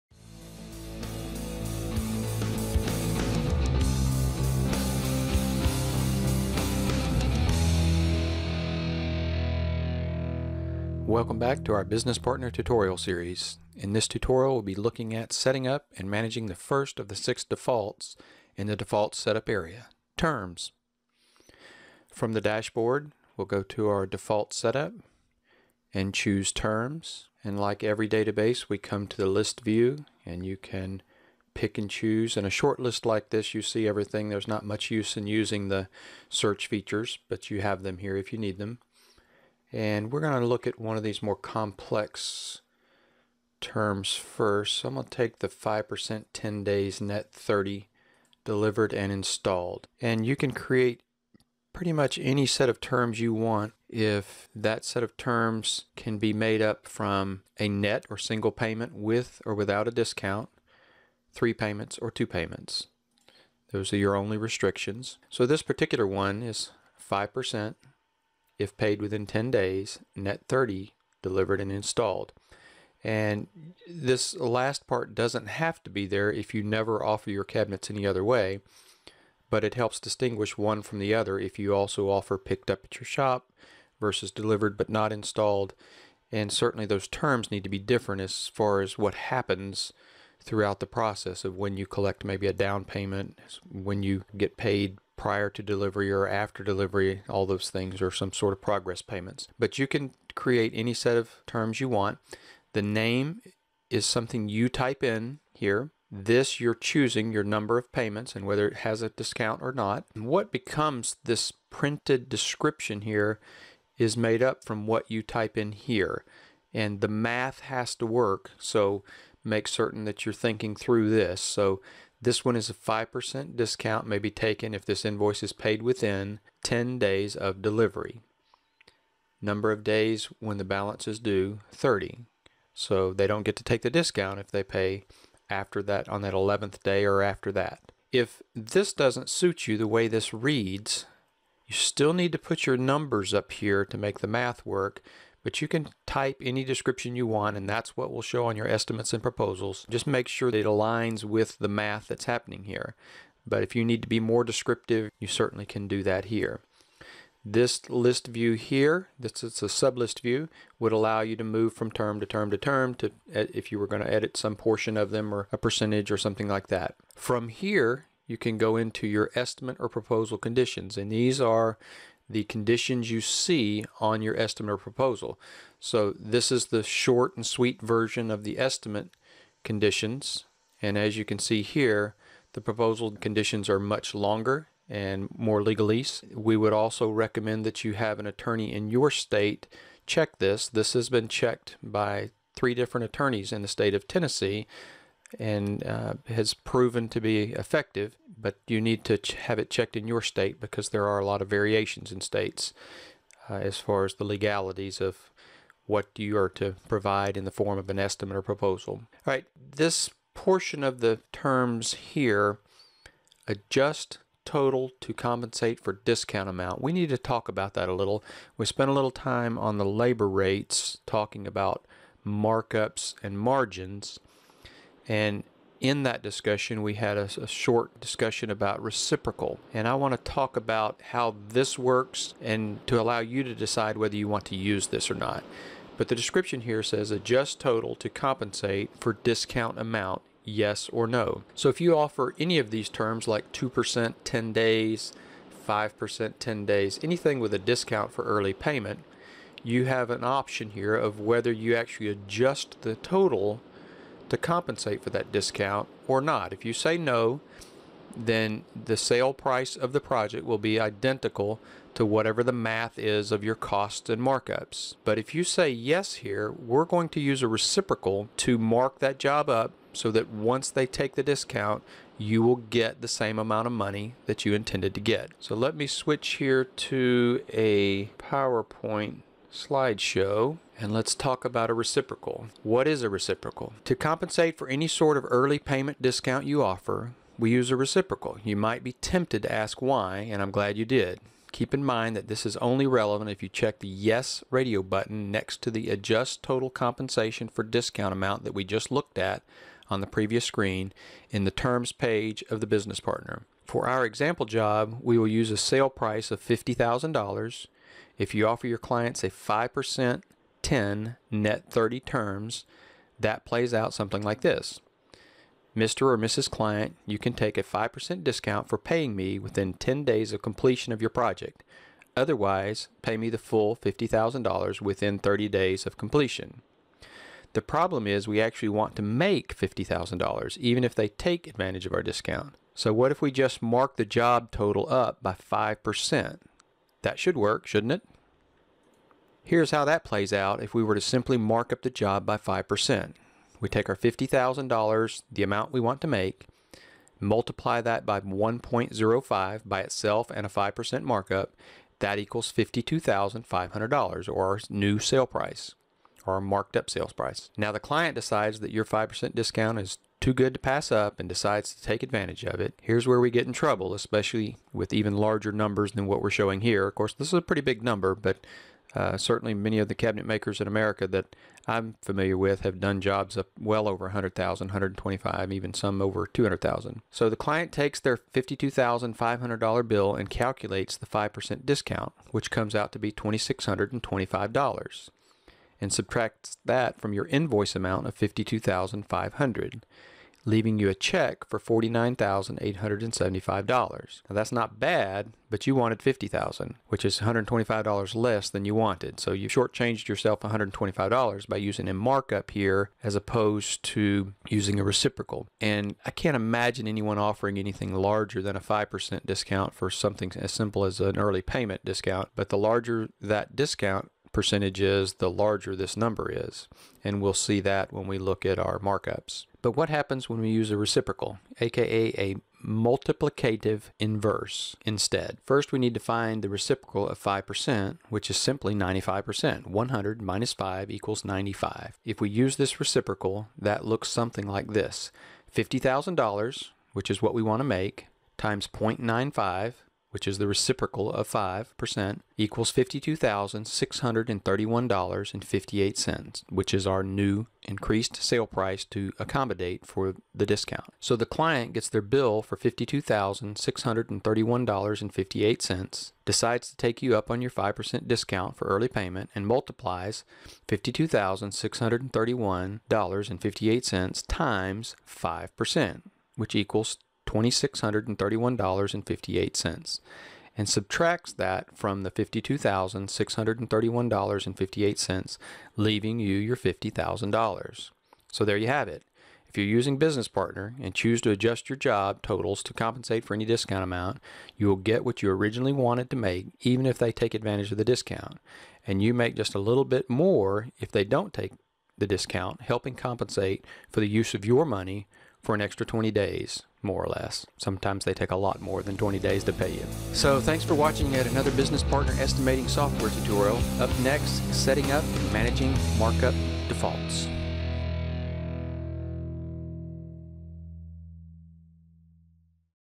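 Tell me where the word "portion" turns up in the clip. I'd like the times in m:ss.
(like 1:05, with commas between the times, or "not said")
2:44, 3:30.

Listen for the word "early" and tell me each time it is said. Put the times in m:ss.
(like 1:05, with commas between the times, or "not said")
4:08, 4:45, 6:51.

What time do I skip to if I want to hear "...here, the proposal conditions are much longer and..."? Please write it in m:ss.
3:01.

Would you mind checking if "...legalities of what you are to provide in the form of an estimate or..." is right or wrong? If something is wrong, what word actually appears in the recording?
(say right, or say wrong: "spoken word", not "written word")
right.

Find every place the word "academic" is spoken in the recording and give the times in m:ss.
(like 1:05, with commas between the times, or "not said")
not said.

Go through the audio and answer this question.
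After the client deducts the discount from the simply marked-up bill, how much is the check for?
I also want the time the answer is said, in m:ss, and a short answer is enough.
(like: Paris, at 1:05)
$49,875, at 6:31.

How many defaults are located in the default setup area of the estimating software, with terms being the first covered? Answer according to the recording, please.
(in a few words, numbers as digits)
6.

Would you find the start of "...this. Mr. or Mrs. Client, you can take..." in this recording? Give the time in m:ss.
5:14.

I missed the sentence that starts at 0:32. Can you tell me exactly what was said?
In a short list like this, you see everything.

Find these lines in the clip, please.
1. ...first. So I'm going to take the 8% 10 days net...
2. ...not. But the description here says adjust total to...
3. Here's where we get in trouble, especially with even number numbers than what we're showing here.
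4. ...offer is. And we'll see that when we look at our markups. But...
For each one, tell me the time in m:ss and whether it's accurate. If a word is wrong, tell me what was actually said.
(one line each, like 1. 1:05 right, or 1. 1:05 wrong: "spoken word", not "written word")
1. 0:44 wrong: "5", not "8"
2. 3:55 right
3. 6:02 wrong: "larger", not "number"
4. 6:55 wrong: "number", not "offer".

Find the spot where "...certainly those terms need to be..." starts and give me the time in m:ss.
1:26.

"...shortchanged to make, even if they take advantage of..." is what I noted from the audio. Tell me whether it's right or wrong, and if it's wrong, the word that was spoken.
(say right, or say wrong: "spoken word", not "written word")
wrong: "wanted", not "shortchanged".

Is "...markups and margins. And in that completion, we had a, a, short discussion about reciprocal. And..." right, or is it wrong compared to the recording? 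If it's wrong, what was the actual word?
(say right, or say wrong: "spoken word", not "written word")
wrong: "discussion", not "completion".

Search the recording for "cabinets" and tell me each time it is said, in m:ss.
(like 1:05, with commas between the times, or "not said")
1:17, 6:09.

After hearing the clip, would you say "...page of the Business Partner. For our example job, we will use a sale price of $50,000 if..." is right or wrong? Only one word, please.
right.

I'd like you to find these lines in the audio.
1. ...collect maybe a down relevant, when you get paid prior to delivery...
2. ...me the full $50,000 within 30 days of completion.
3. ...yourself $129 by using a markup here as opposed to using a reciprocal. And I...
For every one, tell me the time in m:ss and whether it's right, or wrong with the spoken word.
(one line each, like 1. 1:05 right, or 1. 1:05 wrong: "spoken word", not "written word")
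1. 1:31 wrong: "payment", not "relevant"
2. 5:23 right
3. 6:40 wrong: "125", not "129".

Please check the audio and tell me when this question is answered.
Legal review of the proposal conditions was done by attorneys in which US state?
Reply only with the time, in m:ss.
3:14.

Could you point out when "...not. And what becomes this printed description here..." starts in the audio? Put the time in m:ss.
1:49.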